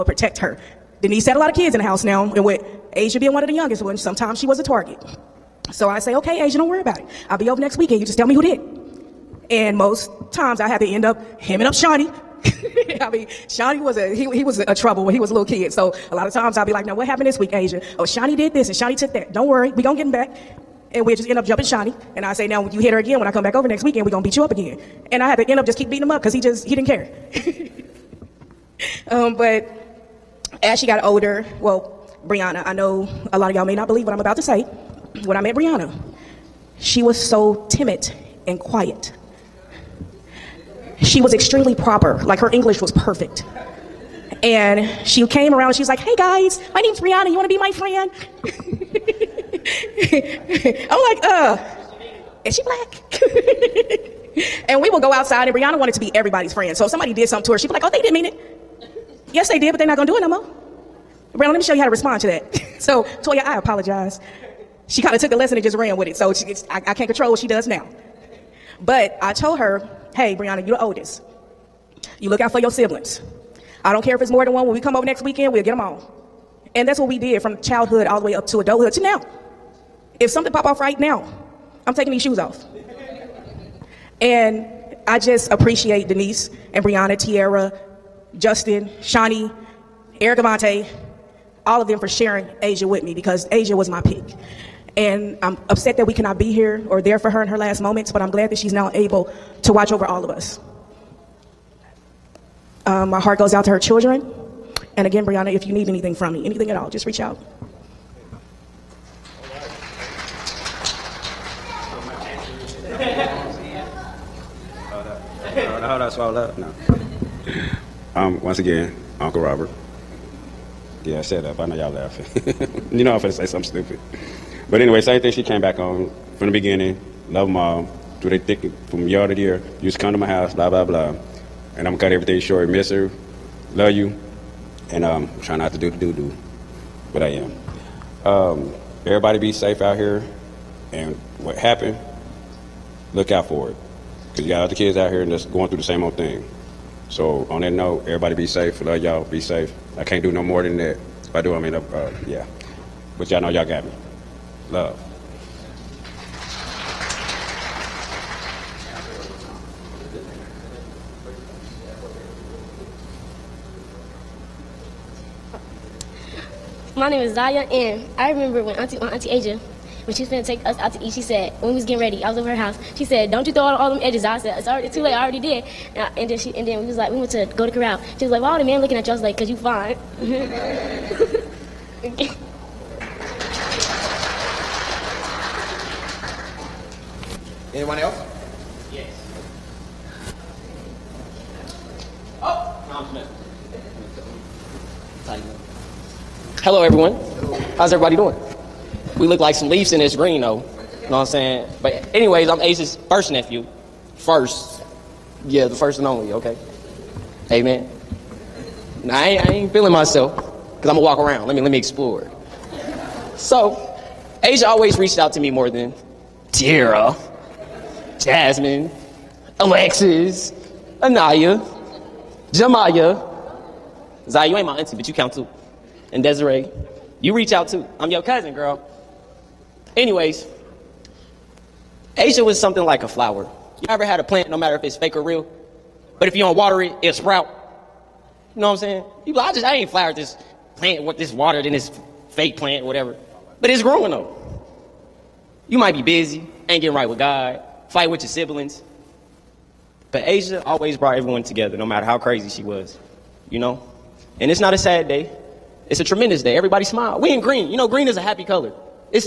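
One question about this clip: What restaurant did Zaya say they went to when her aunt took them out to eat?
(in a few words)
Corral.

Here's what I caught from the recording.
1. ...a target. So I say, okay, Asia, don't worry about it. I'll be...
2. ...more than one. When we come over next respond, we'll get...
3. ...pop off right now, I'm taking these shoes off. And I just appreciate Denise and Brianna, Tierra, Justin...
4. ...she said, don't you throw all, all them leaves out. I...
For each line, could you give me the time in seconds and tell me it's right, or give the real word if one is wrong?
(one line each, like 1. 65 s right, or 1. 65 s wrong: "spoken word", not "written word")
1. 4 s right
2. 74 s wrong: "weekend", not "respond"
3. 80 s right
4. 172 s wrong: "edges", not "leaves".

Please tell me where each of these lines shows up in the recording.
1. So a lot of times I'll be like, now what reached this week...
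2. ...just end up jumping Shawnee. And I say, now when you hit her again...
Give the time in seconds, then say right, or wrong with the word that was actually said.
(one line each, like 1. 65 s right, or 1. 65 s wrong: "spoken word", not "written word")
1. 15 s wrong: "happened", not "reached"
2. 21 s right.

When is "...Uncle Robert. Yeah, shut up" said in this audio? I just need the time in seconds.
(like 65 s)
119 s.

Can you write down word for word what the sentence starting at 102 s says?
Um, my heart goes out to her children.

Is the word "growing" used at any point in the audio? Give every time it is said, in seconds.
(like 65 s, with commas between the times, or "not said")
243 s.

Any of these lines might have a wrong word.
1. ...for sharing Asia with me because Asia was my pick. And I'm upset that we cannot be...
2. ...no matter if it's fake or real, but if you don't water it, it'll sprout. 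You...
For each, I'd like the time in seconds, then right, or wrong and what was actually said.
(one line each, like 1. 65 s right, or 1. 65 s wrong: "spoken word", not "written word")
1. 91 s right
2. 234 s right.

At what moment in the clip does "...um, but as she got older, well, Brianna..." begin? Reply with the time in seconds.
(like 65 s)
29 s.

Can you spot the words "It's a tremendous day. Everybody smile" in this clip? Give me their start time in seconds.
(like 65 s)
255 s.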